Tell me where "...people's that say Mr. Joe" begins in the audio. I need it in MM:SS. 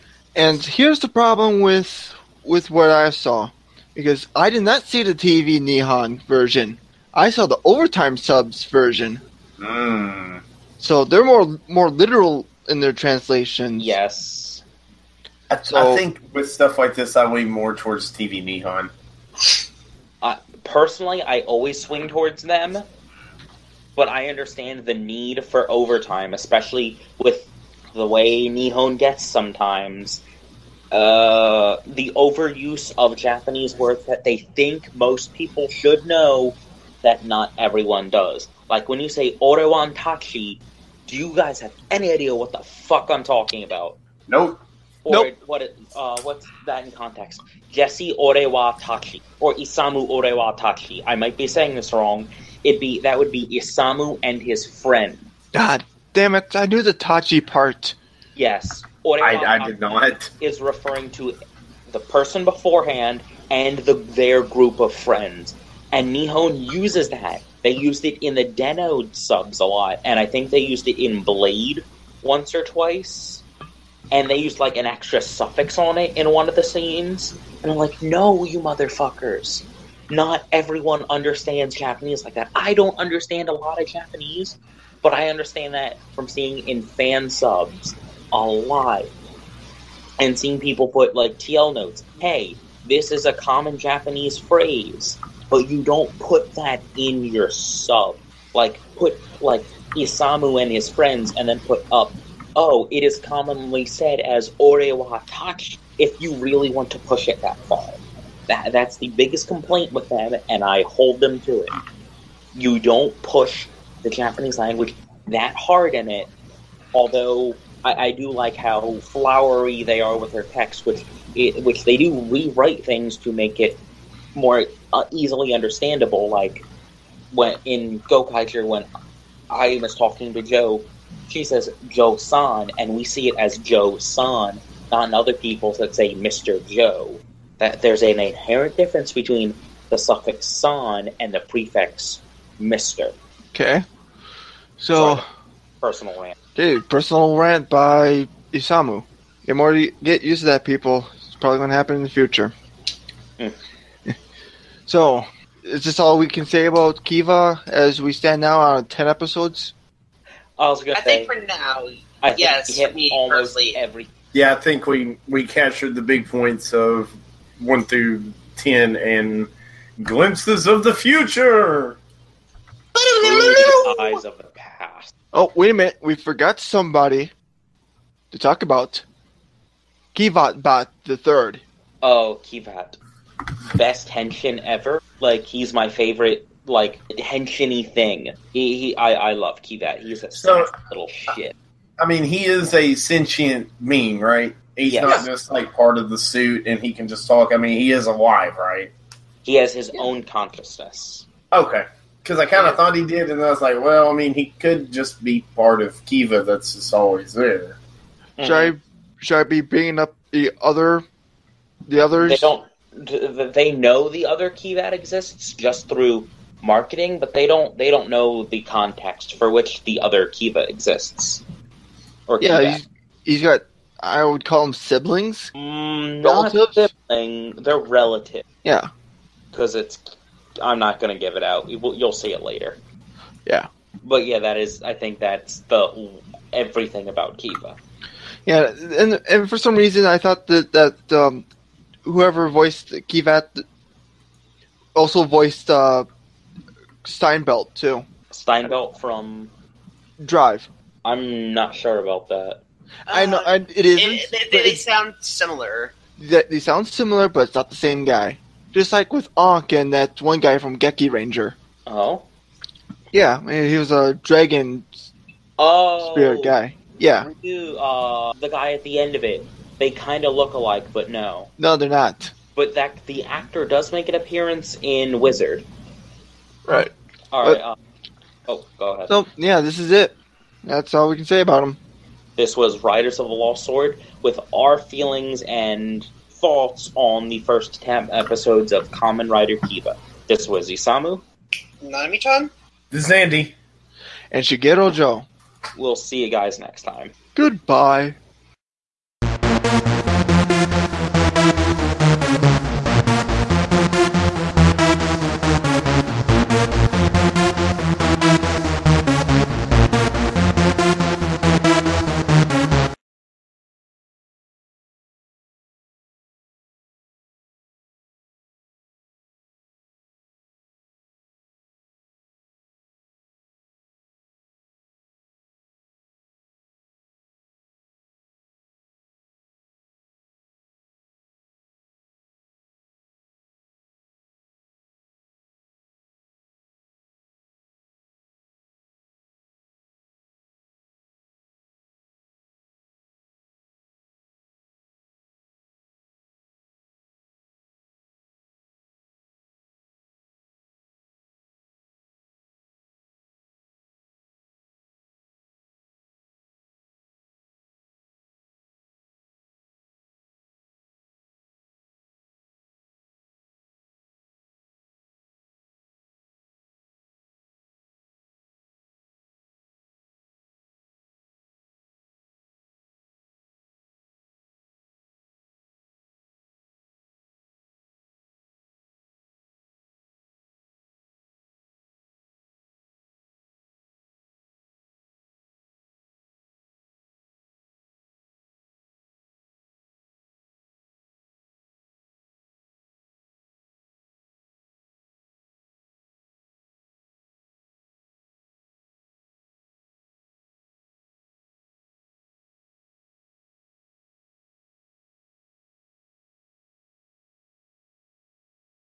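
02:15.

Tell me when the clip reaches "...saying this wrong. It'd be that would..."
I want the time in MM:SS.
00:51.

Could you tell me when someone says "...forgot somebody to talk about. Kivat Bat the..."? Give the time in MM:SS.
02:56.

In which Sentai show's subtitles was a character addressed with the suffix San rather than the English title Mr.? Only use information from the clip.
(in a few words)
Gokaiger.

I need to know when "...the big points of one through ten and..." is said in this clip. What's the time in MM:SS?
02:45.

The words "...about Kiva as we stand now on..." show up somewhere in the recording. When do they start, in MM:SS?
02:36.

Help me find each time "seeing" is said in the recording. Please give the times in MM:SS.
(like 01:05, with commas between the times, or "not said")
01:26, 01:30.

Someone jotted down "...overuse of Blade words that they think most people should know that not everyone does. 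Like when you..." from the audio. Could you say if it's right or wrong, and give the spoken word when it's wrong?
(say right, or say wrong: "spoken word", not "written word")
wrong: "Japanese", not "Blade".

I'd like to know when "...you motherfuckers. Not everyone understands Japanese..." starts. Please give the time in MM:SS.
01:18.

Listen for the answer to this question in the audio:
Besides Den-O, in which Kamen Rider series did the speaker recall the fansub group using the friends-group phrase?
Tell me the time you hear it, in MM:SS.
01:11.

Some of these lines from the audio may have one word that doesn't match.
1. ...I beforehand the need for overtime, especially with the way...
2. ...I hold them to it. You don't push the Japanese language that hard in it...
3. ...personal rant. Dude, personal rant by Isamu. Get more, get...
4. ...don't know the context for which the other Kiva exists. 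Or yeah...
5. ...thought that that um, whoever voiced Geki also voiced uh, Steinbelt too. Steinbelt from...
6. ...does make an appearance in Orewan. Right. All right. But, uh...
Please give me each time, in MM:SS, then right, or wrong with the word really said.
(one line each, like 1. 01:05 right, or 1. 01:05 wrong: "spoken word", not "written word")
1. 00:24 wrong: "understand", not "beforehand"
2. 01:50 right
3. 02:25 right
4. 03:37 right
5. 04:00 wrong: "Kivat", not "Geki"
6. 04:33 wrong: "Wizard", not "Orewan".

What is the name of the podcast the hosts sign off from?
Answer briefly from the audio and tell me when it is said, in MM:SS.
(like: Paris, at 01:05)
Riders of the Lost Zord, at 04:42.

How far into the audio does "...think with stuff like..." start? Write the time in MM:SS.
00:15.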